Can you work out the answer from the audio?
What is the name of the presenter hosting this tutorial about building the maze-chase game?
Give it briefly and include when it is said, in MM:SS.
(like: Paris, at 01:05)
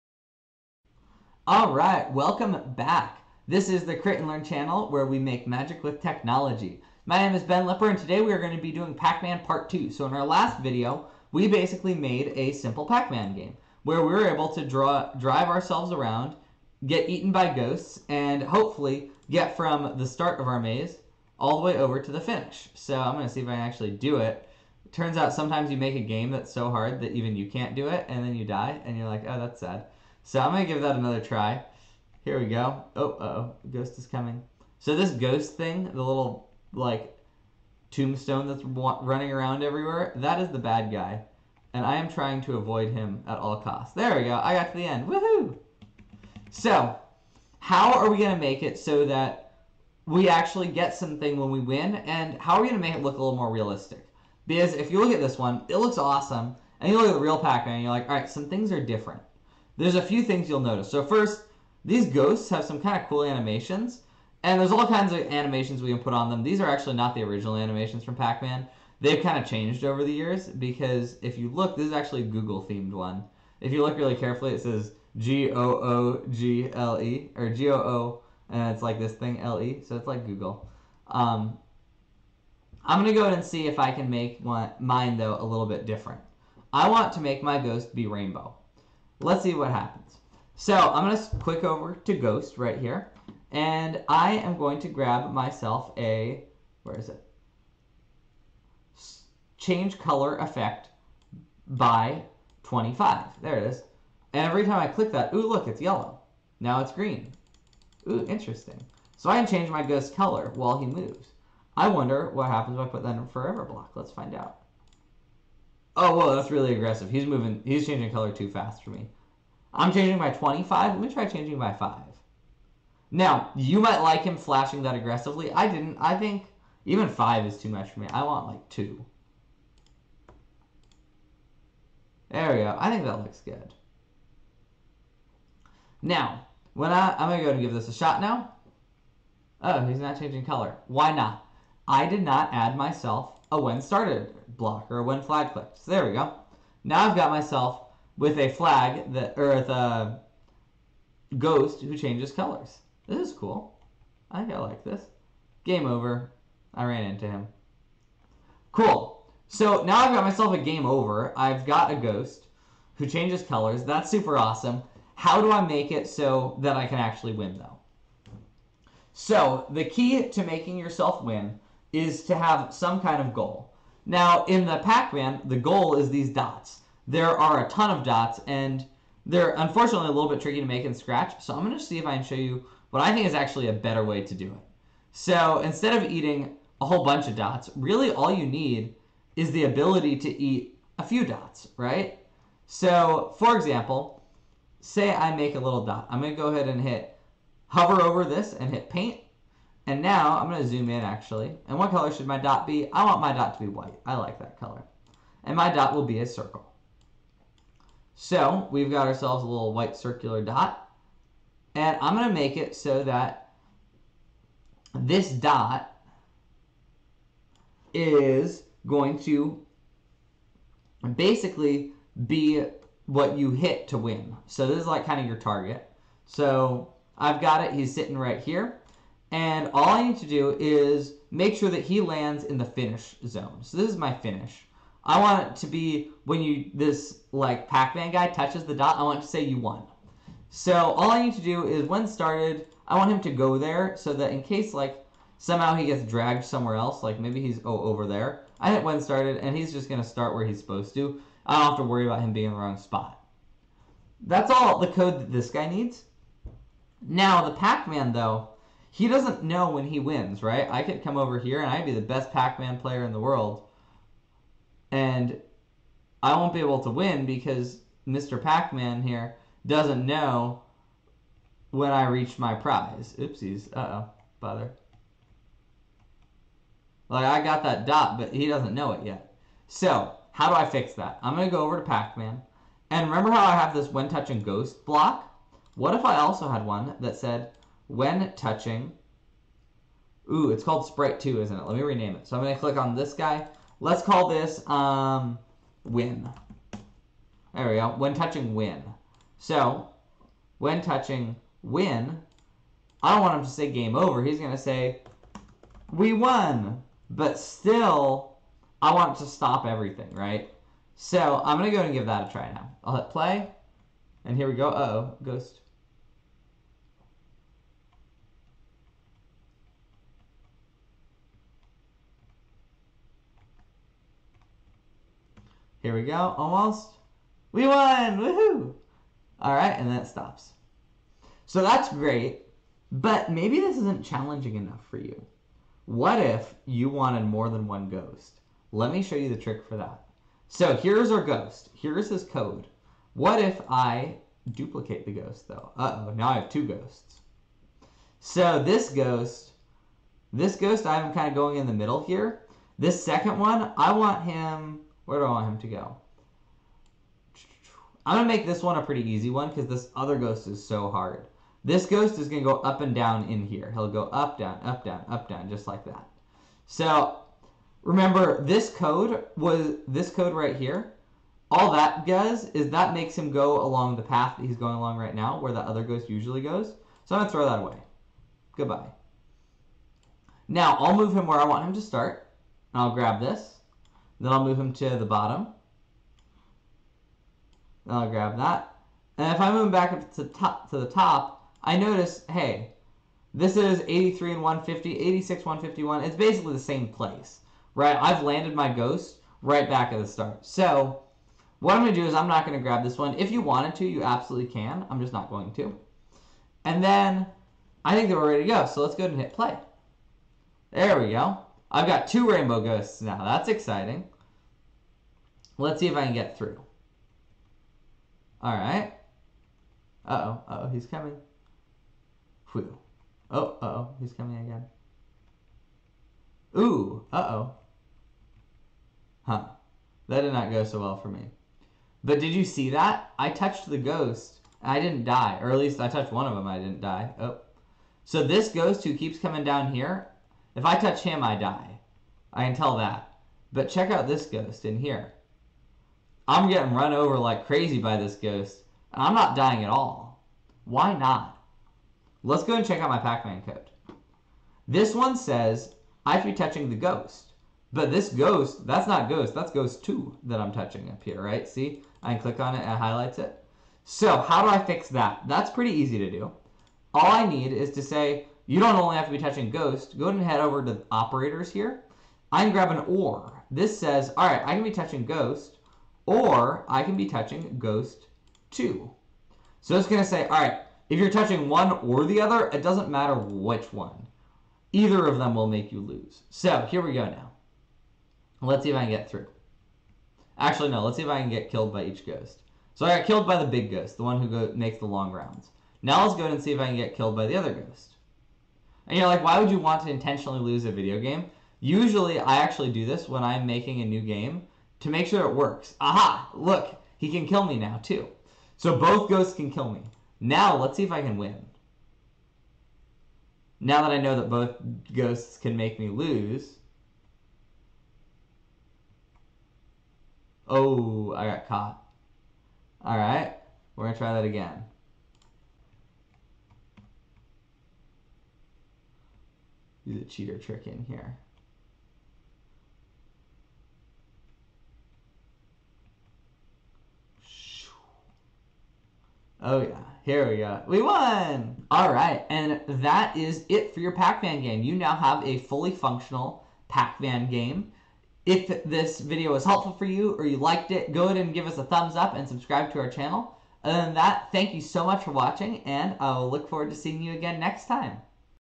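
Ben Lepper, at 00:07.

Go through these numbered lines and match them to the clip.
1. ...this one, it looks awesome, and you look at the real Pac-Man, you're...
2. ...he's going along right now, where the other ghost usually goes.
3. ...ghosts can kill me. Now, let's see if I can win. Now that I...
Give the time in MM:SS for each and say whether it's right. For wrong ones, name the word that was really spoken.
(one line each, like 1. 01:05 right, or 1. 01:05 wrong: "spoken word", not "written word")
1. 00:55 right
2. 06:14 right
3. 08:29 right.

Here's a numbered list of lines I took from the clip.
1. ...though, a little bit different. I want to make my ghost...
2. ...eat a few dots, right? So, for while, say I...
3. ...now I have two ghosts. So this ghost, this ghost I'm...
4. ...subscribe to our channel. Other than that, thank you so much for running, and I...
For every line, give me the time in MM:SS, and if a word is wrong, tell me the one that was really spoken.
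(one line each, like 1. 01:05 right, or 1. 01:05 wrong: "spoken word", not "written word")
1. 01:25 right
2. 03:10 wrong: "example", not "while"
3. 05:46 right
4. 09:12 wrong: "watching", not "running".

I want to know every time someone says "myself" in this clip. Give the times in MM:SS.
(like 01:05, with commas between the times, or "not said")
01:35, 02:22, 02:27, 02:40.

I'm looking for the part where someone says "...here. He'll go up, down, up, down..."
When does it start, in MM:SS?
06:03.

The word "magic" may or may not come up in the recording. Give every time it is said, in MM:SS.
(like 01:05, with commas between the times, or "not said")
00:05.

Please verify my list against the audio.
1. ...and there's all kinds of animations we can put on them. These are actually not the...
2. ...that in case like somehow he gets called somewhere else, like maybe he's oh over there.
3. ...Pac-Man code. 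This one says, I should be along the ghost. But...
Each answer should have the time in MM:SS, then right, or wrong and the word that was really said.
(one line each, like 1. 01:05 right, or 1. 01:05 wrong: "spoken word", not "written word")
1. 01:04 right
2. 04:04 wrong: "dragged", not "called"
3. 07:32 wrong: "touching", not "along".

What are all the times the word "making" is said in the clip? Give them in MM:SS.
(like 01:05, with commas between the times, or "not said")
02:50, 08:23.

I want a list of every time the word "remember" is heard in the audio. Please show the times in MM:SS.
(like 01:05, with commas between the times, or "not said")
04:43, 06:07.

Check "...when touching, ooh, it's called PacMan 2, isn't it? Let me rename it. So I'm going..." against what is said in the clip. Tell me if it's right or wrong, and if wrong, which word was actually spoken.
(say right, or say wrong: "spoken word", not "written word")
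wrong: "Sprite", not "PacMan".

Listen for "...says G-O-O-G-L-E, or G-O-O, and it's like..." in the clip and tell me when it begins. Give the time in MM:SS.
01:14.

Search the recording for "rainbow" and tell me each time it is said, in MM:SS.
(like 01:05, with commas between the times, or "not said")
01:28, 06:52.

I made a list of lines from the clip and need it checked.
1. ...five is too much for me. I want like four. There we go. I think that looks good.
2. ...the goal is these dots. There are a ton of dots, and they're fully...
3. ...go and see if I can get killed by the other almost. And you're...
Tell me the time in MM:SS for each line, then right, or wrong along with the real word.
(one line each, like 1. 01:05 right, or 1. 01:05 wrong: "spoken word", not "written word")
1. 02:07 wrong: "two", not "four"
2. 02:55 wrong: "unfortunately", not "fully"
3. 08:16 wrong: "ghost", not "almost".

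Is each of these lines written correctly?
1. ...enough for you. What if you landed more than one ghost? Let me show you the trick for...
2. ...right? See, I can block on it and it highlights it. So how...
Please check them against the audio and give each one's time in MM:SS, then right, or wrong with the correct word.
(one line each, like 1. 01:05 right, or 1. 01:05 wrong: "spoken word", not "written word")
1. 05:34 wrong: "wanted", not "landed"
2. 07:41 wrong: "click", not "block".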